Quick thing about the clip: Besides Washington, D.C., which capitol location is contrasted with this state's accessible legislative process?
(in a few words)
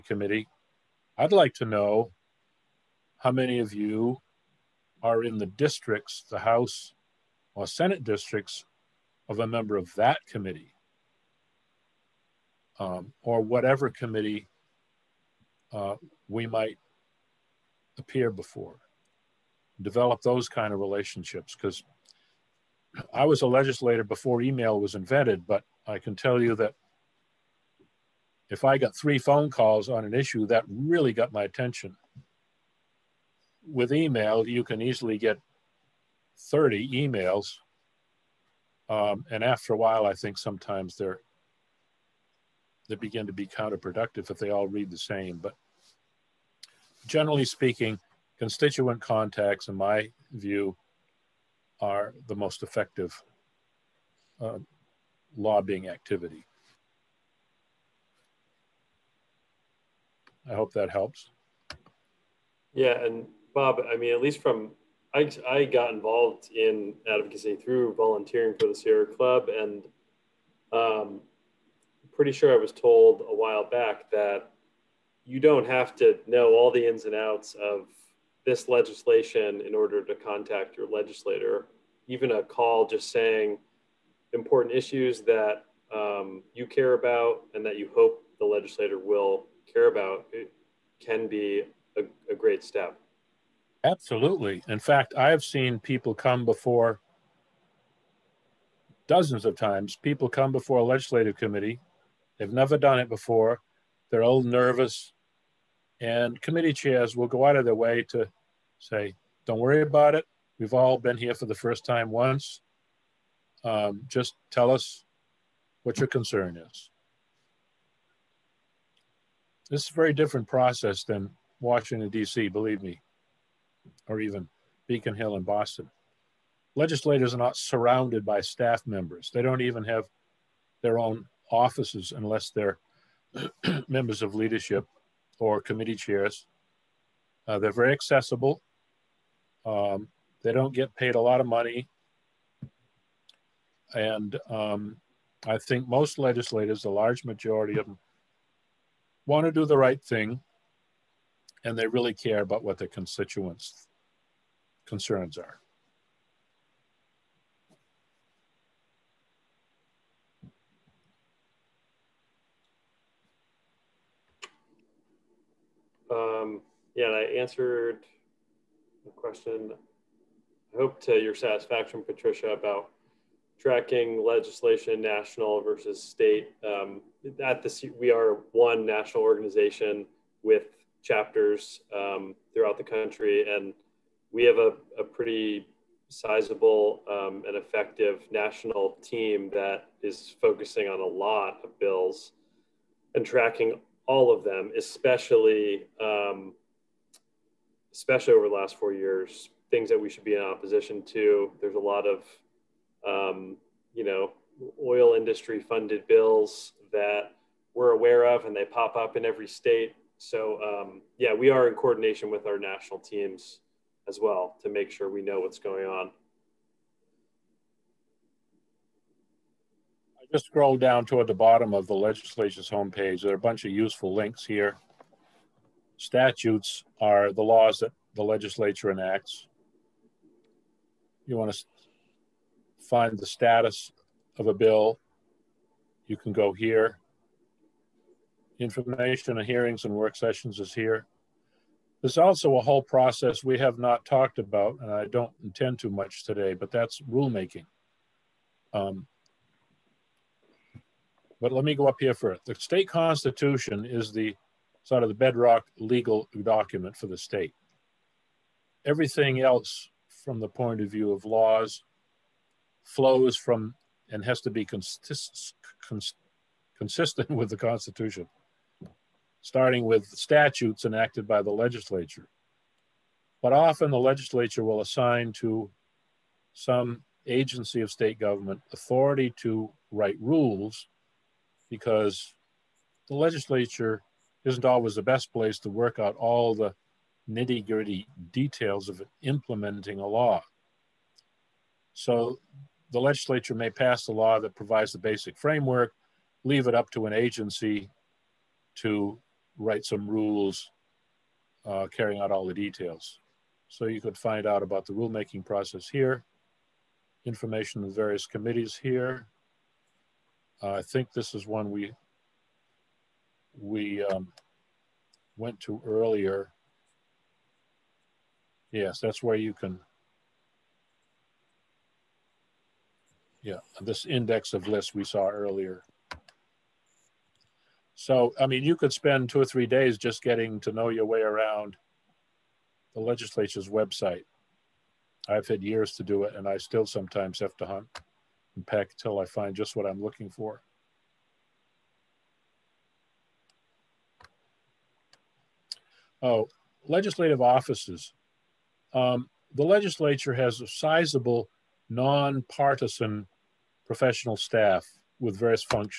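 Beacon Hill.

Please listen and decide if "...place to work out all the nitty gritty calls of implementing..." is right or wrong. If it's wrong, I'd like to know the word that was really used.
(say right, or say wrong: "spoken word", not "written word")
wrong: "details", not "calls".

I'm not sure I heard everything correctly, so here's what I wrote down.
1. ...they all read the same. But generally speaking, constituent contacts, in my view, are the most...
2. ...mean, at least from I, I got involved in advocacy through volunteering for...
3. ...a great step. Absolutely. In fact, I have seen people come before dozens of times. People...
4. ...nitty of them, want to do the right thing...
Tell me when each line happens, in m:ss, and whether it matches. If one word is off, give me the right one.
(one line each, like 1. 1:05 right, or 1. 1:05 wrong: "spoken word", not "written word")
1. 0:44 right
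2. 1:03 right
3. 1:32 right
4. 2:27 wrong: "majority", not "nitty".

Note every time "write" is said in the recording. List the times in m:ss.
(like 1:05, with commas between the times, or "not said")
4:39, 4:59.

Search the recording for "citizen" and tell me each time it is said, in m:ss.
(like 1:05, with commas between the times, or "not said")
not said.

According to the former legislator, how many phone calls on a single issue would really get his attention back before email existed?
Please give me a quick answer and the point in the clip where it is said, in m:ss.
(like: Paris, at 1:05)
3, at 0:28.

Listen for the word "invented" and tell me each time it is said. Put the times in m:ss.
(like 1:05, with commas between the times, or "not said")
0:24.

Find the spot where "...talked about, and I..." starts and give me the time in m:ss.
4:04.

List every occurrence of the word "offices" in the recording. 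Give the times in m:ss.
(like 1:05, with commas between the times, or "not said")
2:11, 5:47.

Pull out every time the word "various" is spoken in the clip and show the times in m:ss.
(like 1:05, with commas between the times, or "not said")
5:07, 5:55.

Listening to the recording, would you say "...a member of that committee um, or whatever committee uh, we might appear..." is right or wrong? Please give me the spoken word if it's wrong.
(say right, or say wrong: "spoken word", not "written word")
right.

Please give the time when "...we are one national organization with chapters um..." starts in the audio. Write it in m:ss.
2:57.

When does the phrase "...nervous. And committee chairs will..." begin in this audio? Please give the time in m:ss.
1:44.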